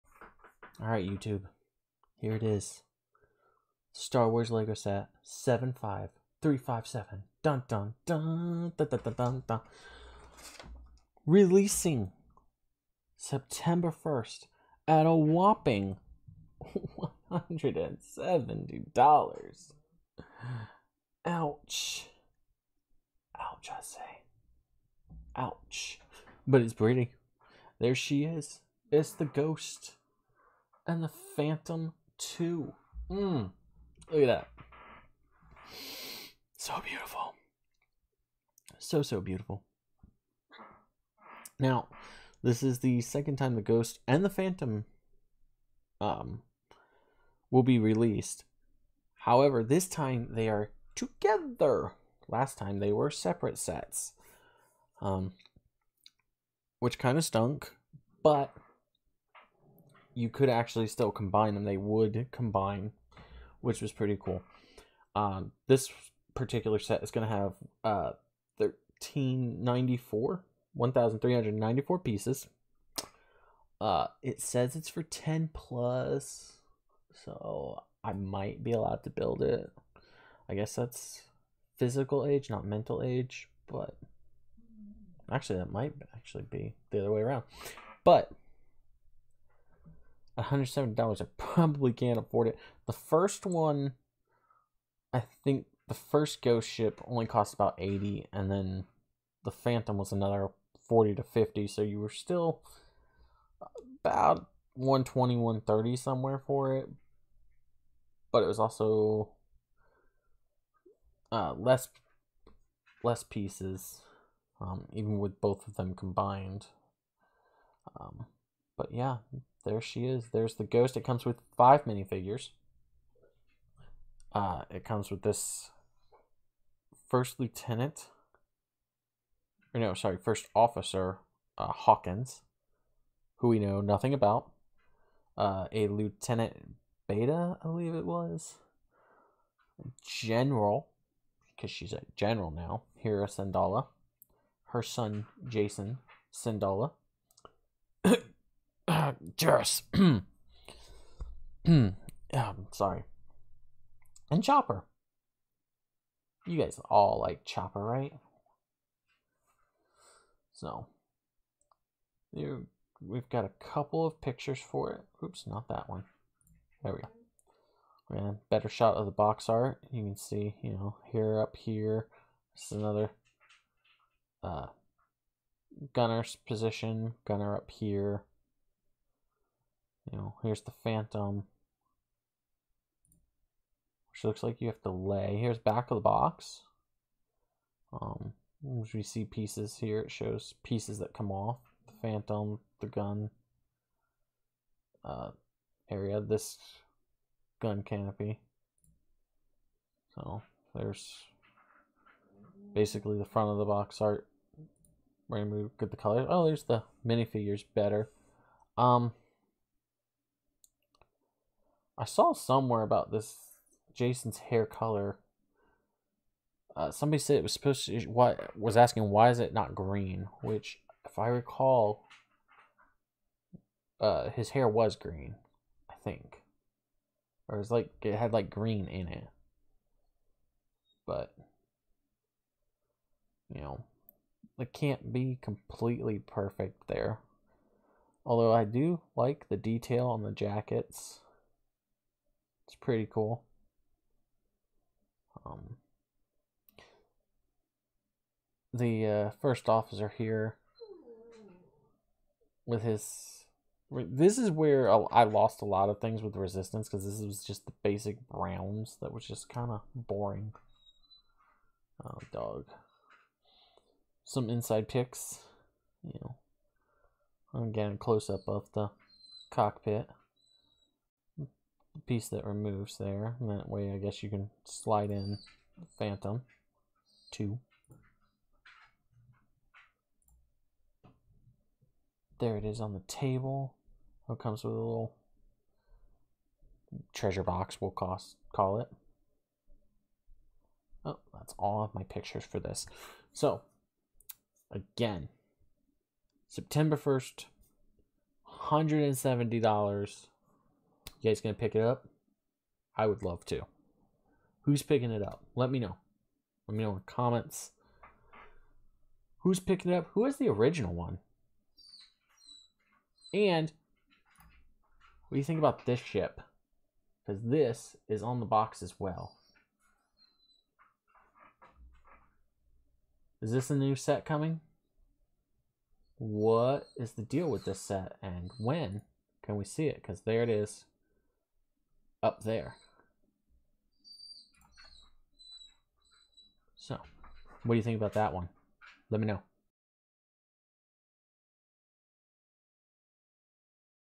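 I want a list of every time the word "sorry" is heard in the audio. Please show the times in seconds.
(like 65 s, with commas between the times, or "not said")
129 s, 152 s.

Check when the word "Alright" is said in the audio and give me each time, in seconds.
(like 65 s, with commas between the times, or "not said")
0 s.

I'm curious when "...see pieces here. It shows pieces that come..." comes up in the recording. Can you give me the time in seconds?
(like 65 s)
189 s.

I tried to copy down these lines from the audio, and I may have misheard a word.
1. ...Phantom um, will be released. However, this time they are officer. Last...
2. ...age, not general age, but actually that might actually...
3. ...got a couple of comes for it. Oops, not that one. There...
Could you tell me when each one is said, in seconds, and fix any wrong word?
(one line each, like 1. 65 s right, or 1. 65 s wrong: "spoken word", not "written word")
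1. 44 s wrong: "together", not "officer"
2. 82 s wrong: "mental", not "general"
3. 163 s wrong: "pictures", not "comes".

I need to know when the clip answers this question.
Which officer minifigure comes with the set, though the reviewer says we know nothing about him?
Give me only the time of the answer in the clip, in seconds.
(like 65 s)
131 s.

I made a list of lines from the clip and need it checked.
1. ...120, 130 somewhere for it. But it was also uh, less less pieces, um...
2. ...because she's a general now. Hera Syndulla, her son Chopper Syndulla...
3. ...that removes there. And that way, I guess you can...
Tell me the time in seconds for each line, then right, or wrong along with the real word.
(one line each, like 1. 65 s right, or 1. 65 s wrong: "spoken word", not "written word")
1. 104 s right
2. 141 s wrong: "Jacen", not "Chopper"
3. 272 s right.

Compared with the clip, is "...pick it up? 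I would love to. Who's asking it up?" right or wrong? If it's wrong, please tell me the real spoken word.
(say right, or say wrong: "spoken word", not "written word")
wrong: "picking", not "asking".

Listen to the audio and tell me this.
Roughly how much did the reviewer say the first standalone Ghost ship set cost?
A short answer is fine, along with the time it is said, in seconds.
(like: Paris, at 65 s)
about 80, at 97 s.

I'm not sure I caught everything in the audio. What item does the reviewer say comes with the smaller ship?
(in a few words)
treasure box.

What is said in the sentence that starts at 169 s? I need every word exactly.
You can see, you know, here up here.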